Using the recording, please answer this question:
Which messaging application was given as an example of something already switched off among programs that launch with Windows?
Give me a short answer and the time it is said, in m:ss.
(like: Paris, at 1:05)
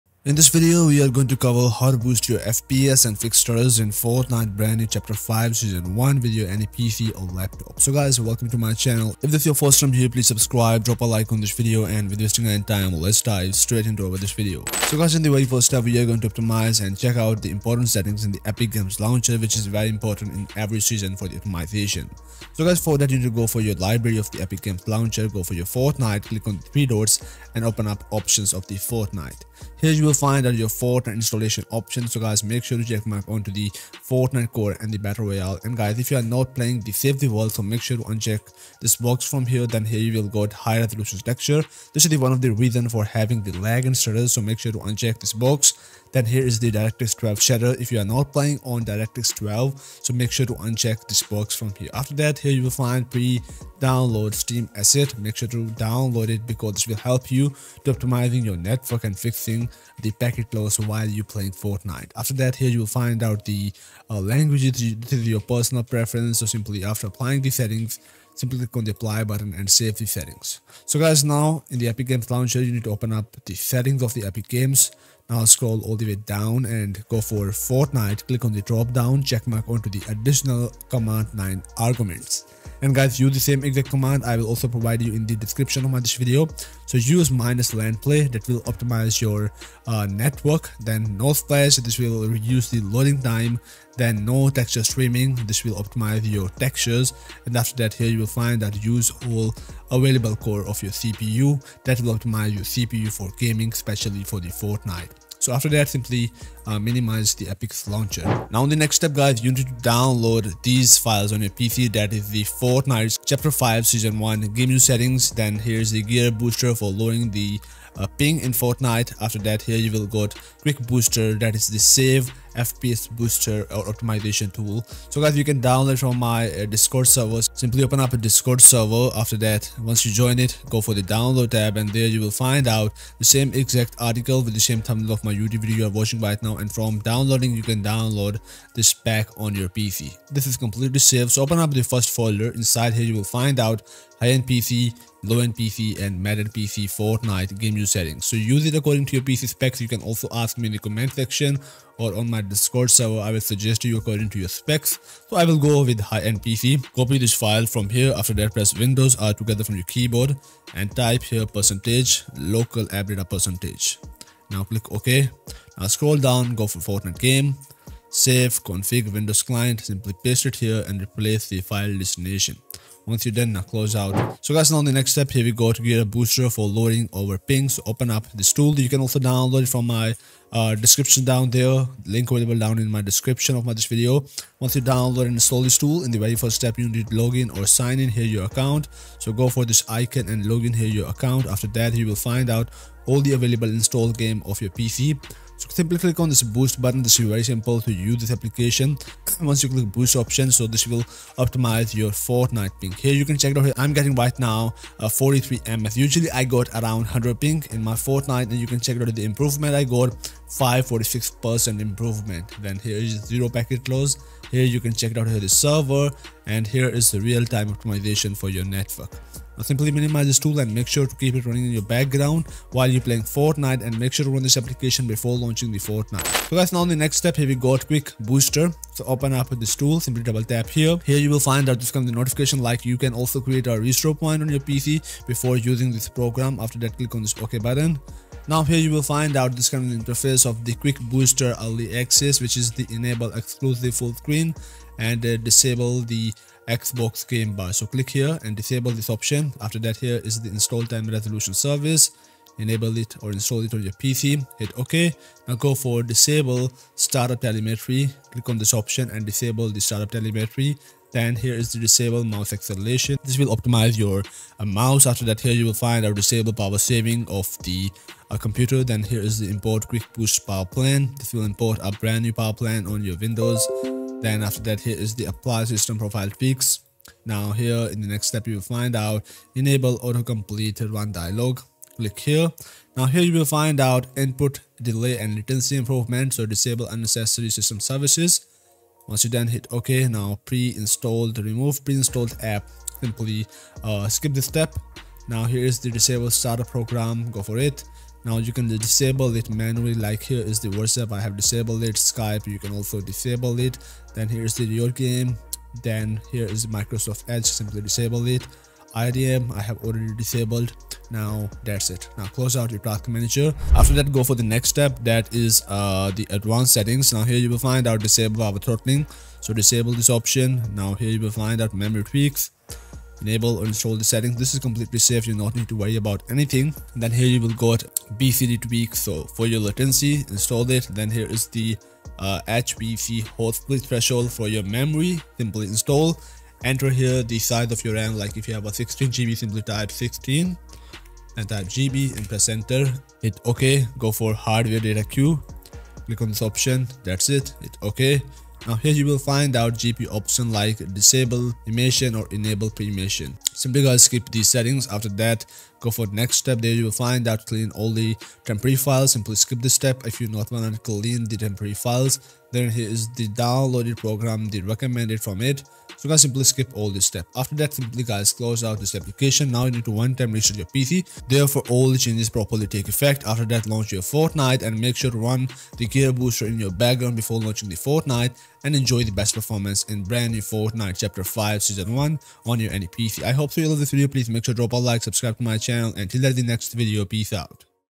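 WhatsApp, at 5:00.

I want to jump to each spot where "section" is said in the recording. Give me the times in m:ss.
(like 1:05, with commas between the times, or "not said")
2:31.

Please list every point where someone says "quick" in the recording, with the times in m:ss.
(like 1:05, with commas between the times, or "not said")
2:00, 3:47, 4:00, 4:29.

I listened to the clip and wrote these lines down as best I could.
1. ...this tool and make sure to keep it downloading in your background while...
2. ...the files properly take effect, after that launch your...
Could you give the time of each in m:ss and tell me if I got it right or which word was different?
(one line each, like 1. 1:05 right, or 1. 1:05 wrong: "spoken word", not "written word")
1. 3:40 wrong: "running", not "downloading"
2. 6:11 wrong: "changes", not "files".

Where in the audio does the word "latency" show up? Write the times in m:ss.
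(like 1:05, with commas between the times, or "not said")
4:45, 5:29.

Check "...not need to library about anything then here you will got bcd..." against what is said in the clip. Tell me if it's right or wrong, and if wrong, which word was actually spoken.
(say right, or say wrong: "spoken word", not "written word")
wrong: "worry", not "library".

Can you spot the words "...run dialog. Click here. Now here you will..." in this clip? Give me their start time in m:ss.
4:40.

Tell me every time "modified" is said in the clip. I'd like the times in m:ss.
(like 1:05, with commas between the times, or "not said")
not said.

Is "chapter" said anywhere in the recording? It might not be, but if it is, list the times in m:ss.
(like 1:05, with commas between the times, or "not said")
0:04, 1:53, 6:20.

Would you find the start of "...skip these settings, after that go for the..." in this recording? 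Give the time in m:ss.
5:54.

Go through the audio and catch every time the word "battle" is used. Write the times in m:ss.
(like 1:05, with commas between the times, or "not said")
0:34.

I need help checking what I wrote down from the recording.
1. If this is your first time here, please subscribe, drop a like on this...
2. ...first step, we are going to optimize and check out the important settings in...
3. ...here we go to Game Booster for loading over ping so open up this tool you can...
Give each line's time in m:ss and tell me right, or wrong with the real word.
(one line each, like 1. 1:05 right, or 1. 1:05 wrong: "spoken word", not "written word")
1. 0:09 right
2. 0:15 right
3. 2:55 wrong: "GearUp", not "Game".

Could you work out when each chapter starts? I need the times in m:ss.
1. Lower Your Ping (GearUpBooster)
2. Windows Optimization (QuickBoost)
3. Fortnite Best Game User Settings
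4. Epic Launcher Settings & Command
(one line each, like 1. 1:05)
1. 2:54
2. 3:45
3. 1:47
4. 0:14.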